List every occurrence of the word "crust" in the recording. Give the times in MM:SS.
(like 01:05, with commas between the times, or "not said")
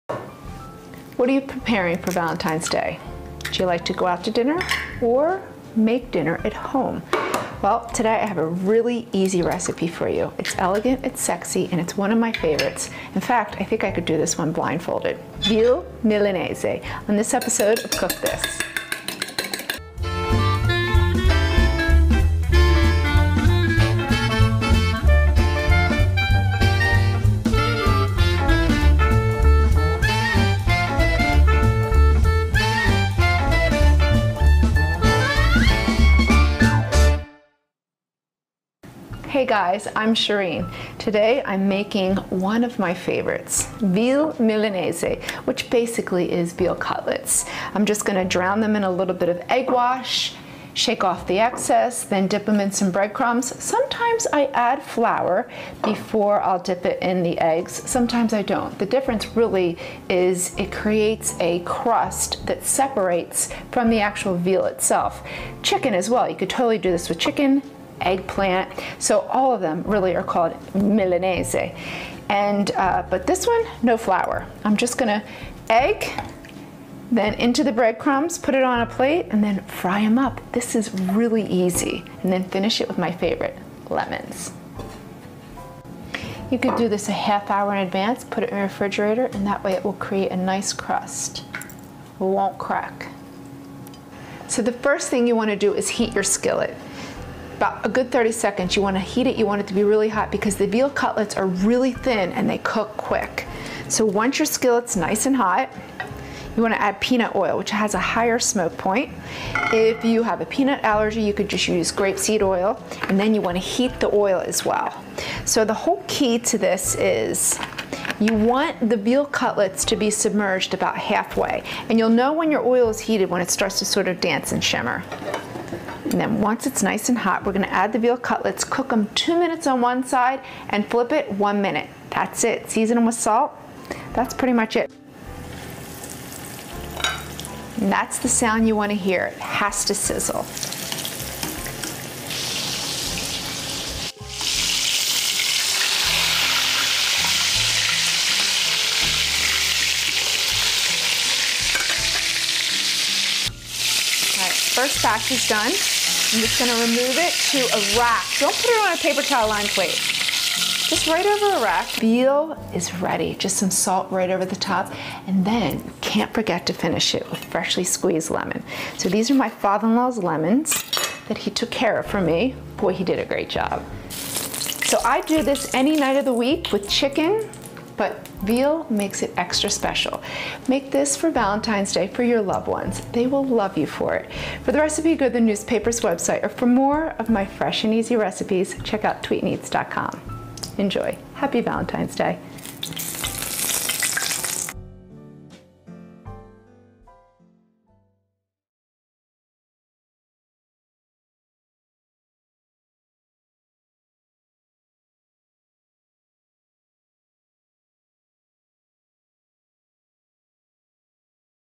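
01:01, 01:30.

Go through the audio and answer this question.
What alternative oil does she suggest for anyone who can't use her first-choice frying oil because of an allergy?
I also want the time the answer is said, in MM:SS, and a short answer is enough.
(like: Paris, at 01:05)
grapeseed oil, at 01:51.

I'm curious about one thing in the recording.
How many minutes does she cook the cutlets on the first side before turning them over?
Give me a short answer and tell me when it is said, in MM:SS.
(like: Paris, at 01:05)
2 minutes, at 02:09.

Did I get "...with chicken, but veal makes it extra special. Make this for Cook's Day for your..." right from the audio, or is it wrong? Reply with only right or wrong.
wrong.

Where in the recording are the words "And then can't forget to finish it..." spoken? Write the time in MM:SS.
02:45.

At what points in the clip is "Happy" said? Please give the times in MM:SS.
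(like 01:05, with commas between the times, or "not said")
03:11.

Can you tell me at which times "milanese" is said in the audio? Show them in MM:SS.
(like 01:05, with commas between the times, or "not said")
00:16, 00:44, 01:10.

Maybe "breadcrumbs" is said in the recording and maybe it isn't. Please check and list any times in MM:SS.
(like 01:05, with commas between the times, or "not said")
00:52, 01:17.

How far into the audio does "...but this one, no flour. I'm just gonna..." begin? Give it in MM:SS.
01:13.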